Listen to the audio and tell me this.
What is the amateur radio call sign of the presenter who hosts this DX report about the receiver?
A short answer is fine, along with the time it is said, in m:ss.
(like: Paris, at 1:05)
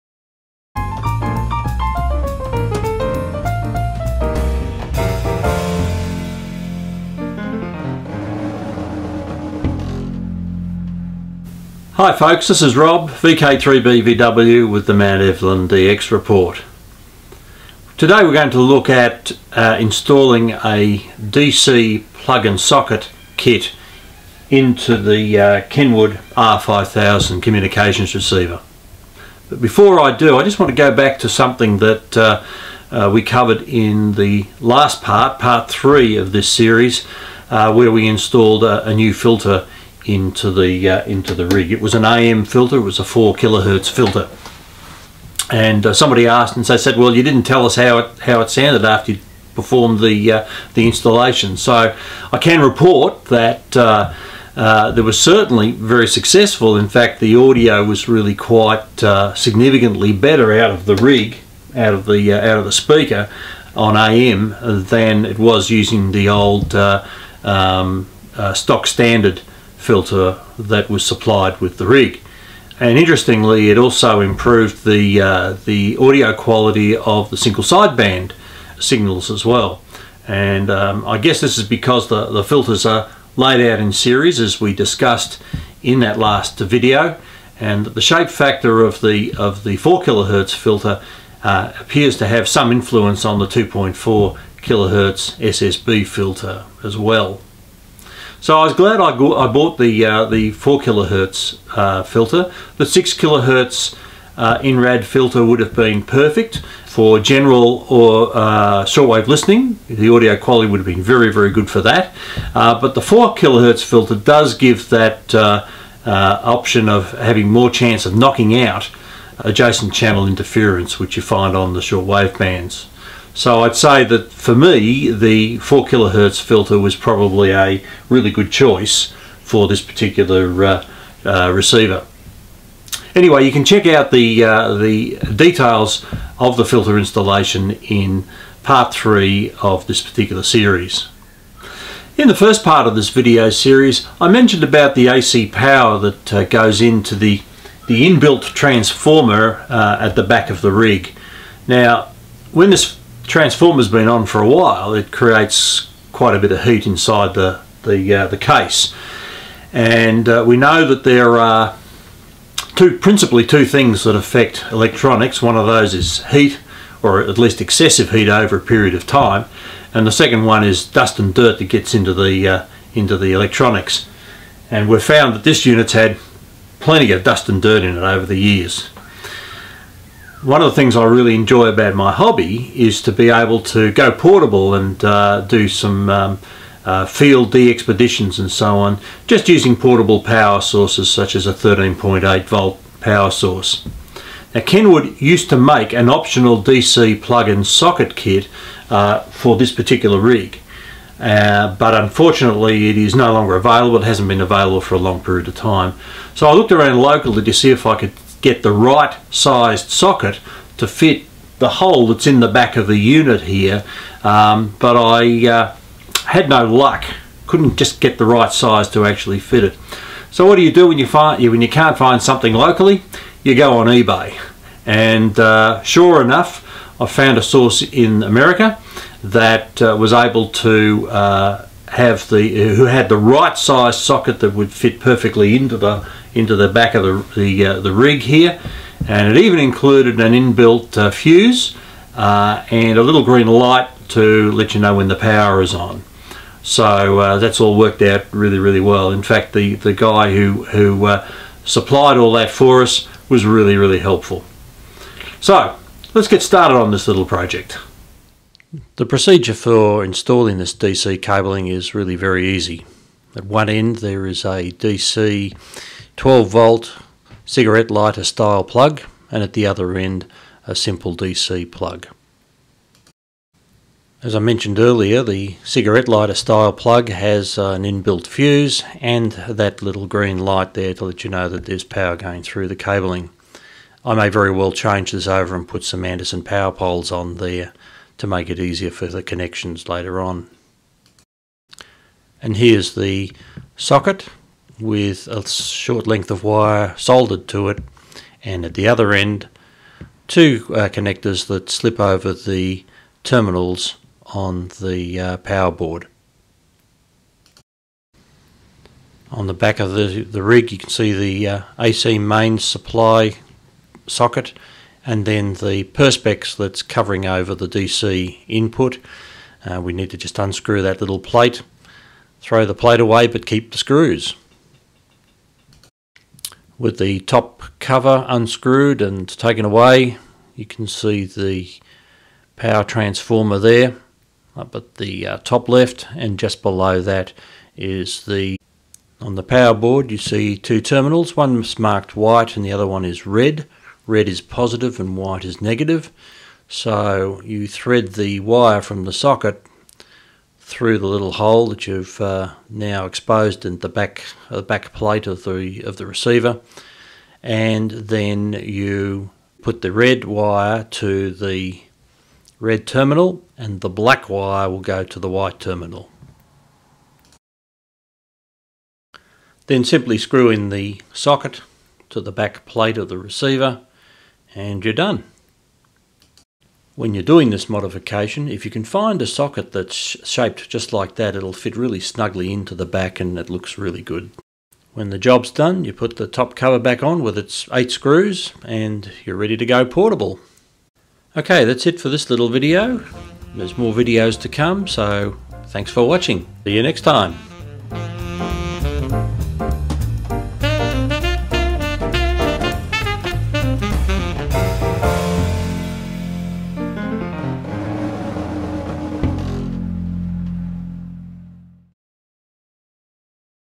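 VK3BVW, at 0:13.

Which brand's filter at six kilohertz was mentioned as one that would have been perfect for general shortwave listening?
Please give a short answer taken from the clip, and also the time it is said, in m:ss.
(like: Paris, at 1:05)
INRAD, at 1:44.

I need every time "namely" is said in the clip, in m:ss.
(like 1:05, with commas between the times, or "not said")
not said.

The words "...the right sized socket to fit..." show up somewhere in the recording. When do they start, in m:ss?
3:28.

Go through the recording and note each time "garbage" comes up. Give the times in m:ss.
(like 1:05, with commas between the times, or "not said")
not said.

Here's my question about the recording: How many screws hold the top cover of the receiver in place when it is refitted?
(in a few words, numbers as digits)
8.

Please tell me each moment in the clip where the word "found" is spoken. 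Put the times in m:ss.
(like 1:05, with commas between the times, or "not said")
2:55, 3:47.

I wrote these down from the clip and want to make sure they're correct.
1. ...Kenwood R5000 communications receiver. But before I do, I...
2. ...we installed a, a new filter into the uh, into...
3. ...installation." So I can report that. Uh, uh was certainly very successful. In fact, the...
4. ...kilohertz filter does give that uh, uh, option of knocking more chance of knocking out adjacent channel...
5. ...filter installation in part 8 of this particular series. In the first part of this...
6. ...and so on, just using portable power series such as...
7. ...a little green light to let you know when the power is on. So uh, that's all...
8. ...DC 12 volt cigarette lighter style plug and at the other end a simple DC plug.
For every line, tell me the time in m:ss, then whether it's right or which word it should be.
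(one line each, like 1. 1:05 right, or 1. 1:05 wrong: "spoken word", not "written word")
1. 0:25 right
2. 0:37 right
3. 0:50 right
4. 1:53 wrong: "having", not "knocking"
5. 2:16 wrong: "3", not "8"
6. 3:08 wrong: "sources", not "series"
7. 4:02 right
8. 4:24 right.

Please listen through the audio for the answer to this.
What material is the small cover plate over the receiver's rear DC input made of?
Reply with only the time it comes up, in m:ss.
5:15.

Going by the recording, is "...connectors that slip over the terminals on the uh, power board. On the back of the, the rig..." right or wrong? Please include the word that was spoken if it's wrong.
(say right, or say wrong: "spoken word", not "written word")
right.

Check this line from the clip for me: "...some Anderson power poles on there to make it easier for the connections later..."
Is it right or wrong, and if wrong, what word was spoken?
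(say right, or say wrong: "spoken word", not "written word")
right.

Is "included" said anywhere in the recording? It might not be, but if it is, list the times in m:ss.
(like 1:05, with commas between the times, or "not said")
3:59.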